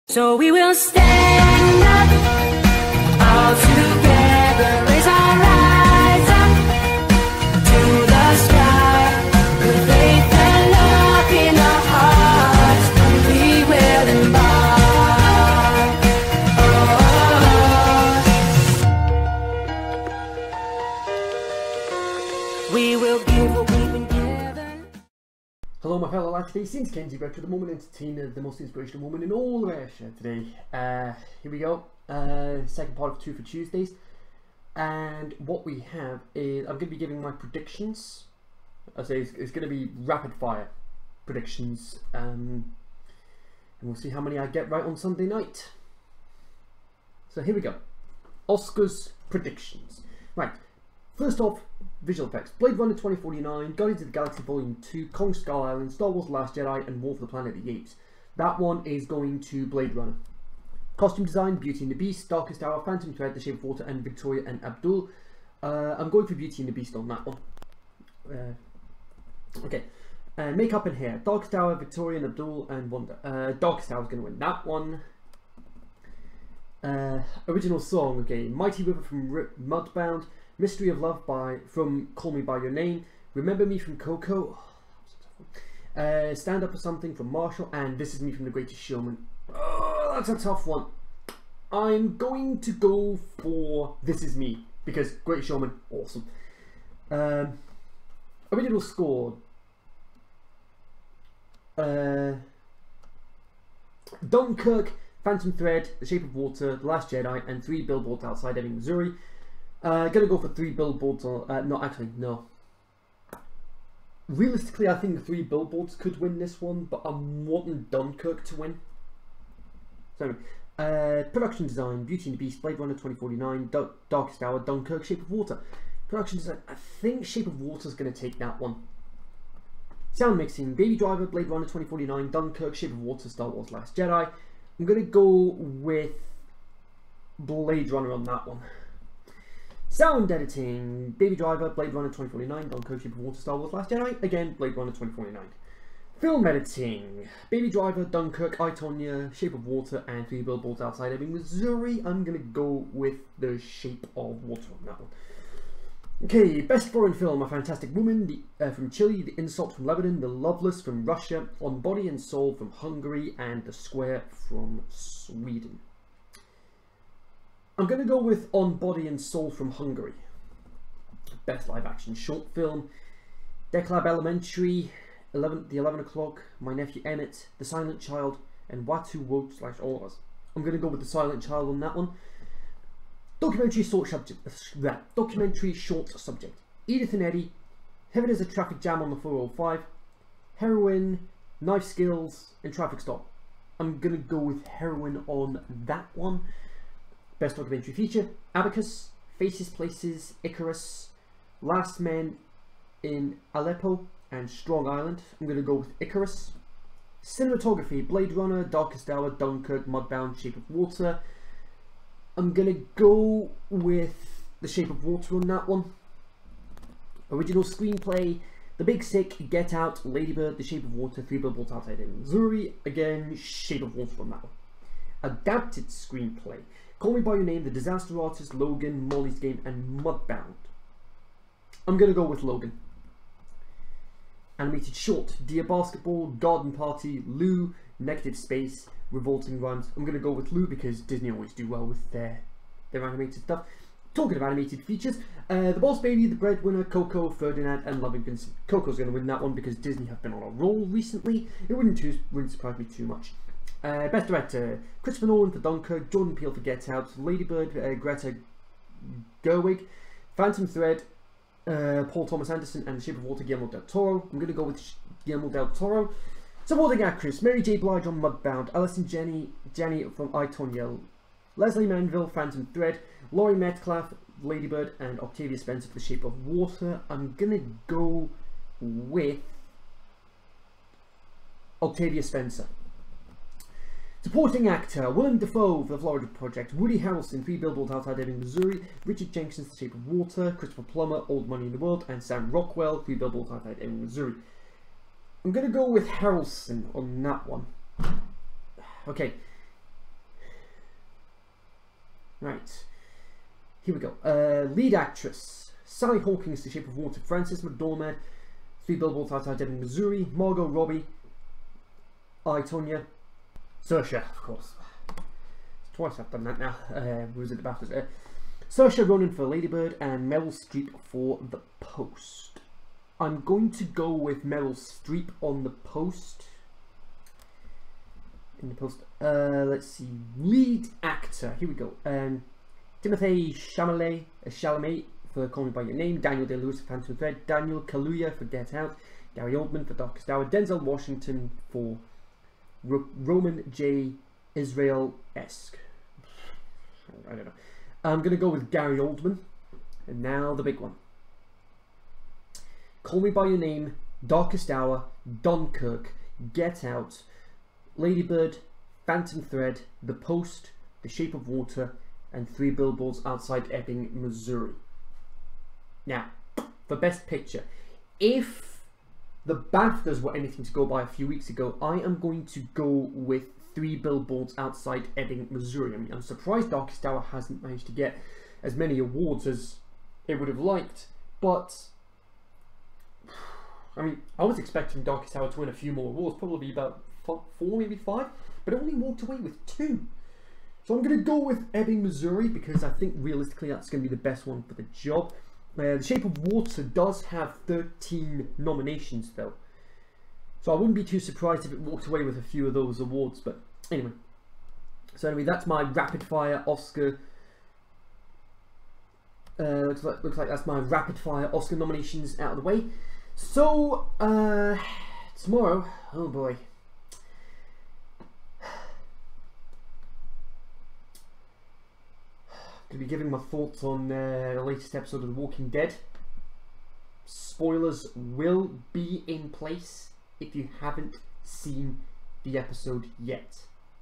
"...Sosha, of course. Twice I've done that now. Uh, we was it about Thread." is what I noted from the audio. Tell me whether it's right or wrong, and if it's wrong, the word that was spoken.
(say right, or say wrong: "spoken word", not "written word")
wrong: "Baftas", not "Thread".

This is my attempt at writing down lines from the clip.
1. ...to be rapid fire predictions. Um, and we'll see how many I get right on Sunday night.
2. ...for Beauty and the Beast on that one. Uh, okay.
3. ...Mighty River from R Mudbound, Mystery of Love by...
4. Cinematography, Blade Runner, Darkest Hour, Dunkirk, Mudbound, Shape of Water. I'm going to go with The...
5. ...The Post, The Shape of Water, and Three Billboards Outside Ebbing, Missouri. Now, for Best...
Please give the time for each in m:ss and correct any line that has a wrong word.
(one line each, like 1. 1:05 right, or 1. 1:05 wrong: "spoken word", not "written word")
1. 0:39 right
2. 1:06 right
3. 1:18 right
4. 3:27 right
5. 6:00 right.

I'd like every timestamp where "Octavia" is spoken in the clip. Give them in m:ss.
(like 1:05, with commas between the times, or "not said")
4:35, 4:41.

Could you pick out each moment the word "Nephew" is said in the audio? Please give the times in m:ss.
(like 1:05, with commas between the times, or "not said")
2:56.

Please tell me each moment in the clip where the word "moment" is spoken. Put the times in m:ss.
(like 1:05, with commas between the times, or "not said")
0:27.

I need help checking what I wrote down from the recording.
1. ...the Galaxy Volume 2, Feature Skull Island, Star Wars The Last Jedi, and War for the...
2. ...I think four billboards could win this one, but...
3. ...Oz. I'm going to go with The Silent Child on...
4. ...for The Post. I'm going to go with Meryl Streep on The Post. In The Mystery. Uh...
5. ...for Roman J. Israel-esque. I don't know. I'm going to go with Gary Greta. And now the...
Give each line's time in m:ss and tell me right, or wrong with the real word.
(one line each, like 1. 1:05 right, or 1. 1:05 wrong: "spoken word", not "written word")
1. 0:54 wrong: "Kong", not "Feature"
2. 1:54 wrong: "three", not "four"
3. 2:59 right
4. 5:21 wrong: "Post", not "Mystery"
5. 5:41 wrong: "Oldman", not "Greta".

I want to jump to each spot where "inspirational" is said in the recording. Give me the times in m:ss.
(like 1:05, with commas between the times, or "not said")
0:28.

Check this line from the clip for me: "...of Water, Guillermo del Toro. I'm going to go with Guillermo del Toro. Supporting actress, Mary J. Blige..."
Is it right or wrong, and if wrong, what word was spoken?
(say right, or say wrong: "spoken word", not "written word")
right.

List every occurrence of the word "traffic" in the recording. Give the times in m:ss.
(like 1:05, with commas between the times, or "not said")
3:08, 3:12.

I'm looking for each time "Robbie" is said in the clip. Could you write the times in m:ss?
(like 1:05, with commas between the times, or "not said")
5:10.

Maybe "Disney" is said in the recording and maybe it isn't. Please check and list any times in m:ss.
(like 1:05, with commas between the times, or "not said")
4:01, 4:09.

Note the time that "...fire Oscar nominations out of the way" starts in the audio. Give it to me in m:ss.
6:51.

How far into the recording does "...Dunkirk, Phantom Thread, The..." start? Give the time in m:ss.
1:44.